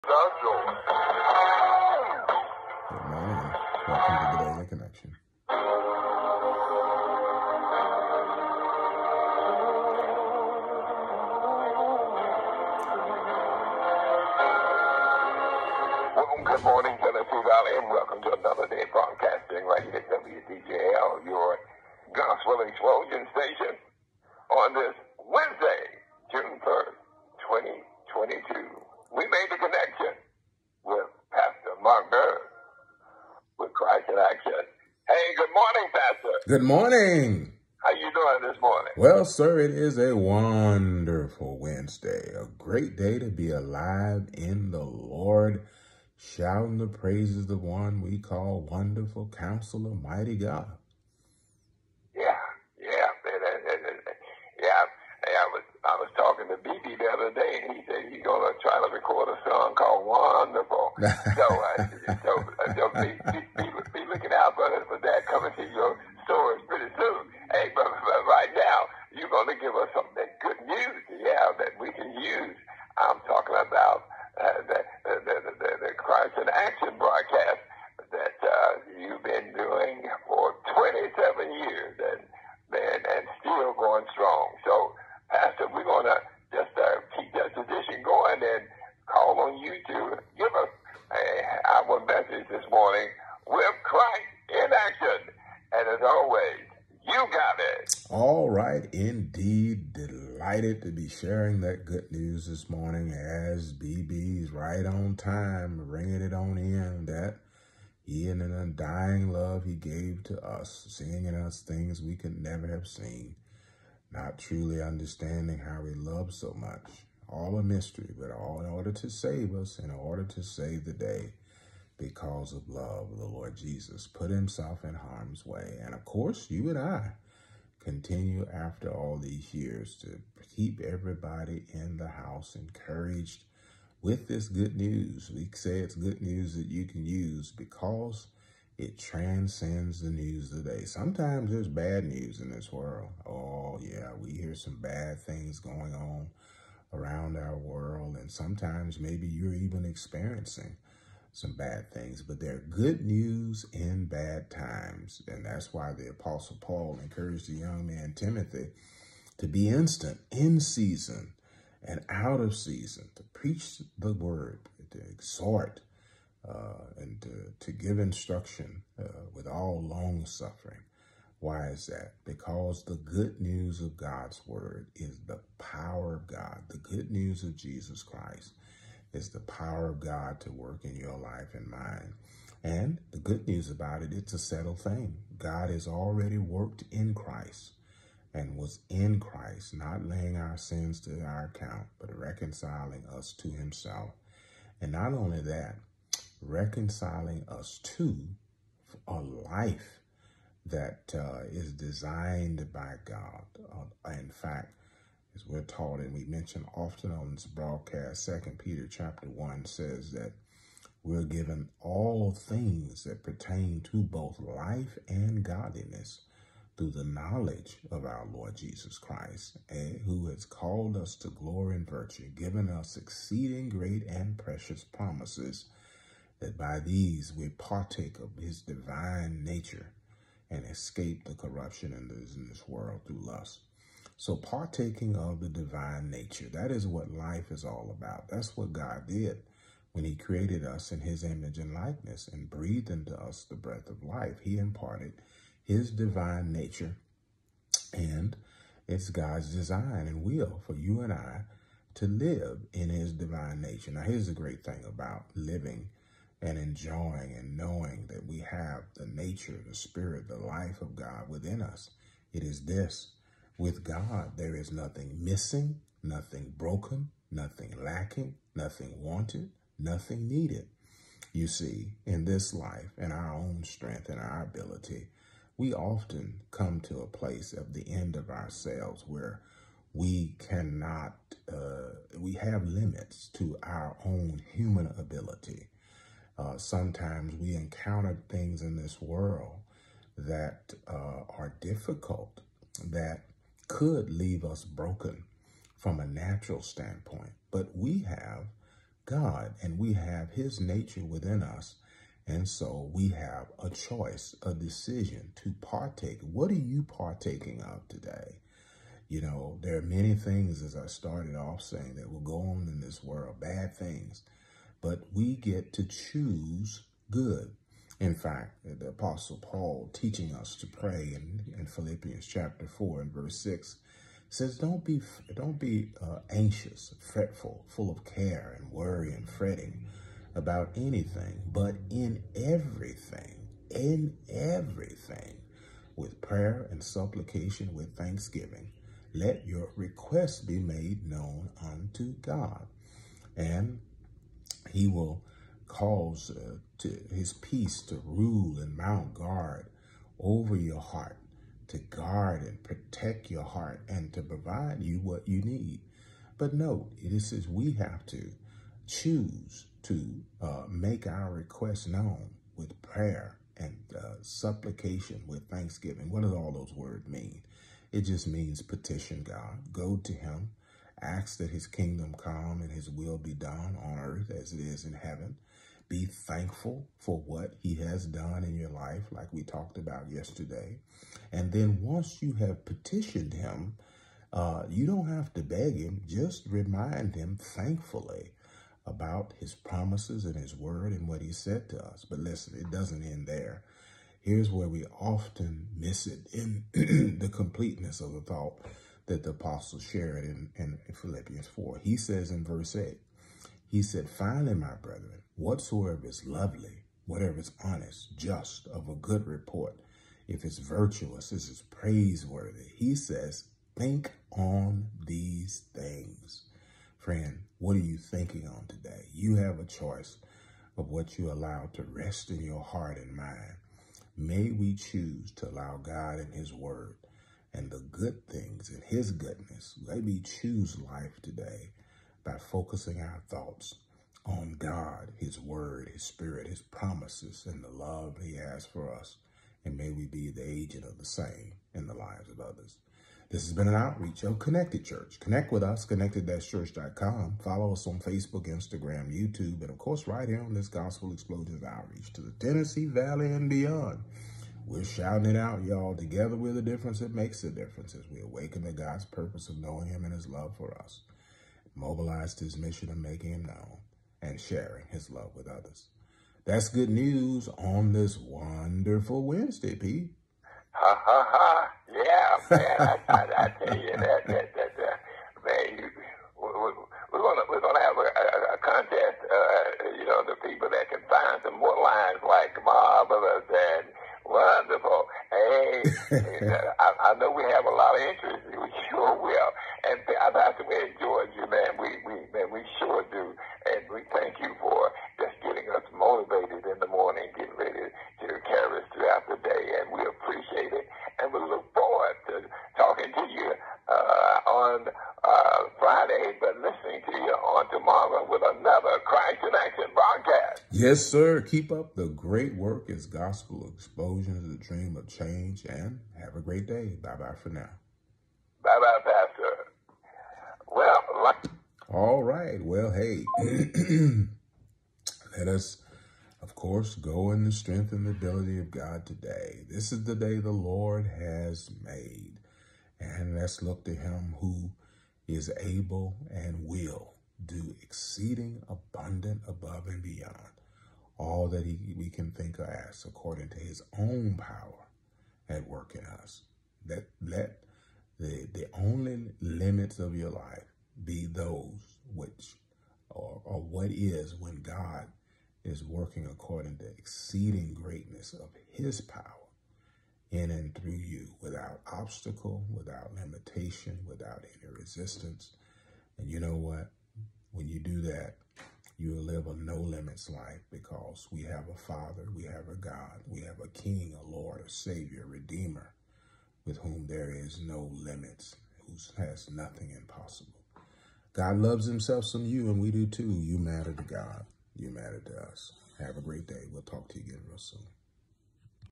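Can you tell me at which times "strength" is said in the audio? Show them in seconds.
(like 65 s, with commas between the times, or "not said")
273 s, 527 s.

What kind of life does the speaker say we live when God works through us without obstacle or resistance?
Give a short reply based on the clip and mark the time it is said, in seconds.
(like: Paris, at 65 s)
A no limits life, at 569 s.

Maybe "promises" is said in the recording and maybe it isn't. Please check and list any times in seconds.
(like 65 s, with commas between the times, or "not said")
224 s, 389 s, 436 s.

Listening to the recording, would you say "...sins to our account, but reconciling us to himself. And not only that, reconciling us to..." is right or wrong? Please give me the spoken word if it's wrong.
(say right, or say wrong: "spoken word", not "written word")
right.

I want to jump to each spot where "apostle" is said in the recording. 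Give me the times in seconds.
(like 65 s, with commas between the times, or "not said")
156 s, 318 s, 399 s.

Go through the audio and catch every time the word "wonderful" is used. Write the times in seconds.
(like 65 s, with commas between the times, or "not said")
40 s, 48 s, 60 s, 468 s, 484 s.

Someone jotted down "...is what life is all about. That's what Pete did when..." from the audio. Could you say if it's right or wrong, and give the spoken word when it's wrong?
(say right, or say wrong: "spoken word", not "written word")
wrong: "God", not "Pete".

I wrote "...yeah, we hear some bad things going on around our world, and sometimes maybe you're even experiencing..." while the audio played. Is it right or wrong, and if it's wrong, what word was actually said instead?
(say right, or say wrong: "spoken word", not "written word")
right.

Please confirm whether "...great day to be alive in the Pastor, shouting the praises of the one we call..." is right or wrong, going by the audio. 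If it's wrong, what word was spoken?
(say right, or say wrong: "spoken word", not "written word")
wrong: "Lord", not "Pastor".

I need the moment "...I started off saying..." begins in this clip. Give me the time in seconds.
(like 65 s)
310 s.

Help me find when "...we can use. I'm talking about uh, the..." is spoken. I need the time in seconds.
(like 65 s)
71 s.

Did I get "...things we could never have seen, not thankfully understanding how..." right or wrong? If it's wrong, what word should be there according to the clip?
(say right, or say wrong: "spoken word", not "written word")
wrong: "truly", not "thankfully".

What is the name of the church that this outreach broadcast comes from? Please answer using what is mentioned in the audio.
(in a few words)
Connected Church.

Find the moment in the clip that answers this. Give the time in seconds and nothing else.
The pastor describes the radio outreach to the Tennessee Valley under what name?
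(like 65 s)
450 s.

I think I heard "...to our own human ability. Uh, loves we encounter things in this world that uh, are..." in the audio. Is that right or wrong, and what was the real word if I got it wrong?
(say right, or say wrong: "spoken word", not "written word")
wrong: "sometimes", not "loves".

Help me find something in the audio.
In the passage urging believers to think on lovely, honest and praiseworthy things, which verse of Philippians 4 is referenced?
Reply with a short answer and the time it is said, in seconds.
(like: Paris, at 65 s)
Verse 8, at 402 s.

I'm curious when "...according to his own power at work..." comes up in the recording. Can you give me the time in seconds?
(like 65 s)
543 s.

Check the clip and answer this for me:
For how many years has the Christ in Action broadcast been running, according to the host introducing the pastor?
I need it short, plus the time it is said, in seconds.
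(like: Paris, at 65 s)
27, at 80 s.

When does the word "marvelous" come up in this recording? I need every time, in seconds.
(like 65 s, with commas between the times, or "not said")
482 s.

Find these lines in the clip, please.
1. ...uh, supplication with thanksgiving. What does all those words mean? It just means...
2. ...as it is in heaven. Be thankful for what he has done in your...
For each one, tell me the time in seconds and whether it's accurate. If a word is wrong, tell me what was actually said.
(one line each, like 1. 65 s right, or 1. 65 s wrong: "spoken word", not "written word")
1. 363 s right
2. 374 s right.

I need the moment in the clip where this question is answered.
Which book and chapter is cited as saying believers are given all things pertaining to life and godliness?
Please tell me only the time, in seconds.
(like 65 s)
208 s.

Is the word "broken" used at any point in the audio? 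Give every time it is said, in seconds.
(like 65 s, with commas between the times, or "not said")
266 s, 294 s.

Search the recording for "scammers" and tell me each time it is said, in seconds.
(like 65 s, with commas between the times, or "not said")
not said.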